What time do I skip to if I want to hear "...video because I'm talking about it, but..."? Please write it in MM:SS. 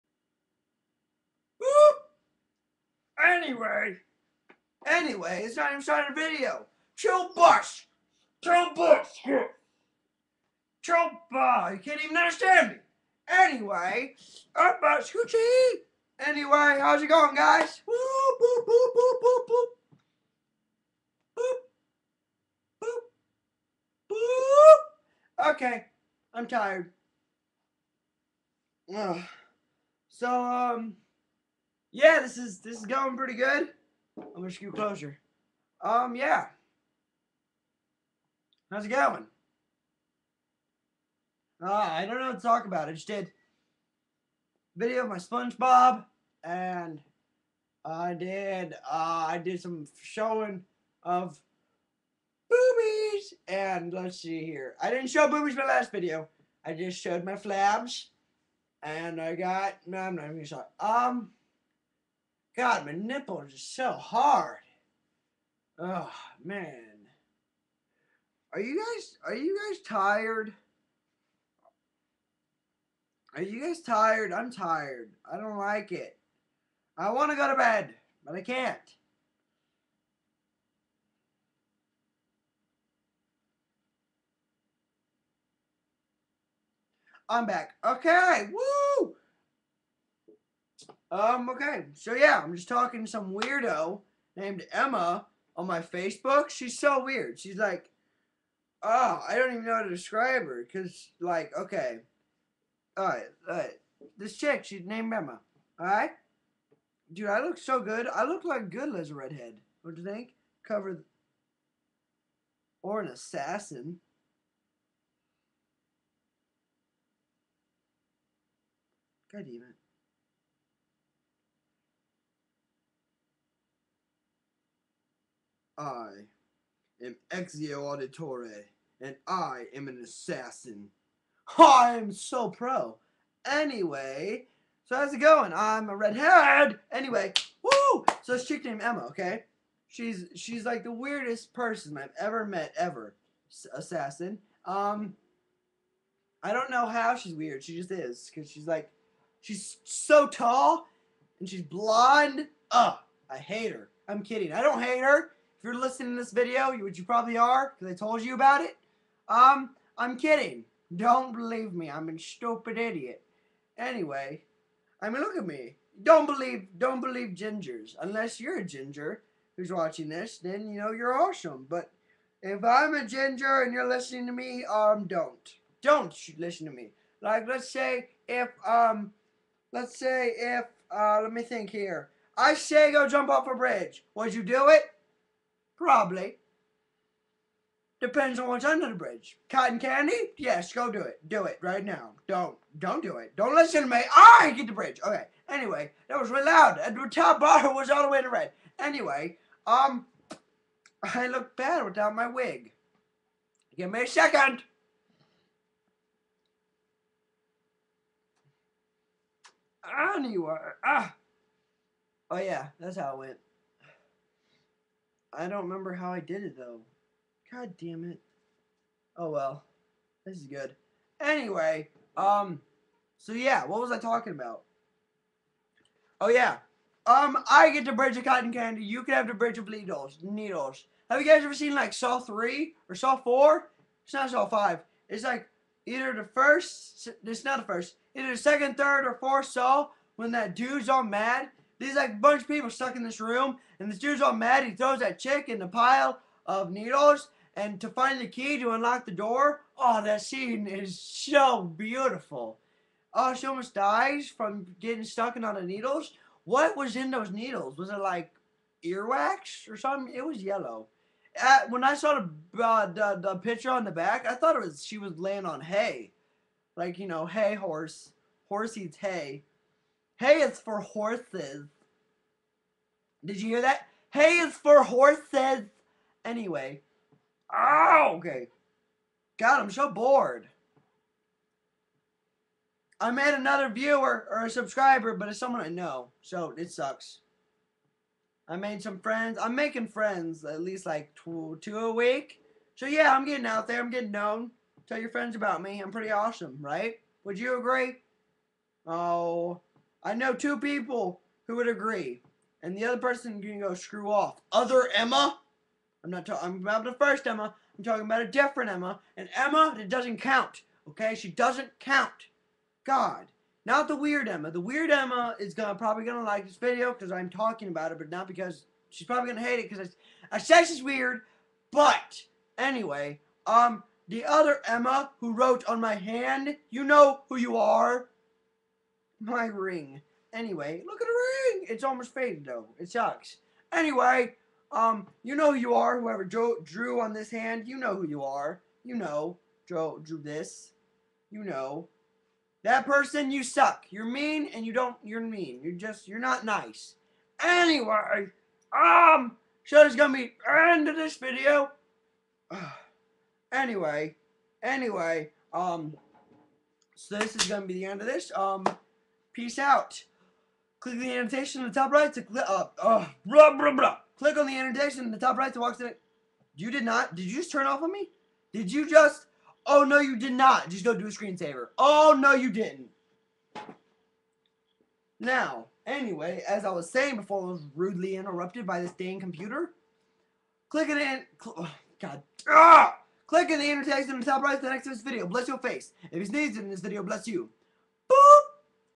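05:16.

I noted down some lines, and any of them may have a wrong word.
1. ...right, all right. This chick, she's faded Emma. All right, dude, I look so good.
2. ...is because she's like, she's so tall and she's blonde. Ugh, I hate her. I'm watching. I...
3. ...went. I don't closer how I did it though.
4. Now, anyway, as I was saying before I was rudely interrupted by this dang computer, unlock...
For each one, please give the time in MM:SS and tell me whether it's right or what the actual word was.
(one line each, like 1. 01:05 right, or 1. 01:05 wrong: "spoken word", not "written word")
1. 01:43 wrong: "named", not "faded"
2. 02:27 wrong: "kidding", not "watching"
3. 03:33 wrong: "remember", not "closer"
4. 06:15 wrong: "click", not "unlock".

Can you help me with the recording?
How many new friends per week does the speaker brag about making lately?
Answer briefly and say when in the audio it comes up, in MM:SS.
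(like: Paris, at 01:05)
2 a week, at 04:51.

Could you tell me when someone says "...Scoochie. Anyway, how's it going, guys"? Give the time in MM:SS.
00:15.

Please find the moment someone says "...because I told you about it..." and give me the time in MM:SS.
02:37.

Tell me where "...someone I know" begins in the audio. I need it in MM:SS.
04:45.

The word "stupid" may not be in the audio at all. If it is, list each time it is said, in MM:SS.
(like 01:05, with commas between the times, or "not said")
02:42.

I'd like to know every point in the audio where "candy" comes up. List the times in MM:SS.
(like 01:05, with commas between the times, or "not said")
03:09, 03:48.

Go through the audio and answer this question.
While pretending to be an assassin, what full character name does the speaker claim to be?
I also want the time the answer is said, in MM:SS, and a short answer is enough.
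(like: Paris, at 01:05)
Ezio Auditore, at 02:07.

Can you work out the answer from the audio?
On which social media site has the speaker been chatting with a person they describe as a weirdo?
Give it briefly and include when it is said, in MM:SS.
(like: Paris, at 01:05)
Facebook, at 01:35.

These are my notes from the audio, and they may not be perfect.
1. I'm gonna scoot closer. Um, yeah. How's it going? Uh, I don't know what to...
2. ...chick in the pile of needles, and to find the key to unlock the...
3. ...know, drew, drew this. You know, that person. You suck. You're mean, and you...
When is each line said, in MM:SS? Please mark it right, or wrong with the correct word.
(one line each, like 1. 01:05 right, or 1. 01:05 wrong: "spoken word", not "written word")
1. 00:34 right
2. 04:05 right
3. 05:38 right.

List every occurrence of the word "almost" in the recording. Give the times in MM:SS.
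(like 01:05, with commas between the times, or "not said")
04:13, 05:31.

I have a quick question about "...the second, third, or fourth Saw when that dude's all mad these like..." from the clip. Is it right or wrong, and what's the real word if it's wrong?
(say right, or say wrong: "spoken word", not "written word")
right.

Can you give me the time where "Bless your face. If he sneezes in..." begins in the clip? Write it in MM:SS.
06:25.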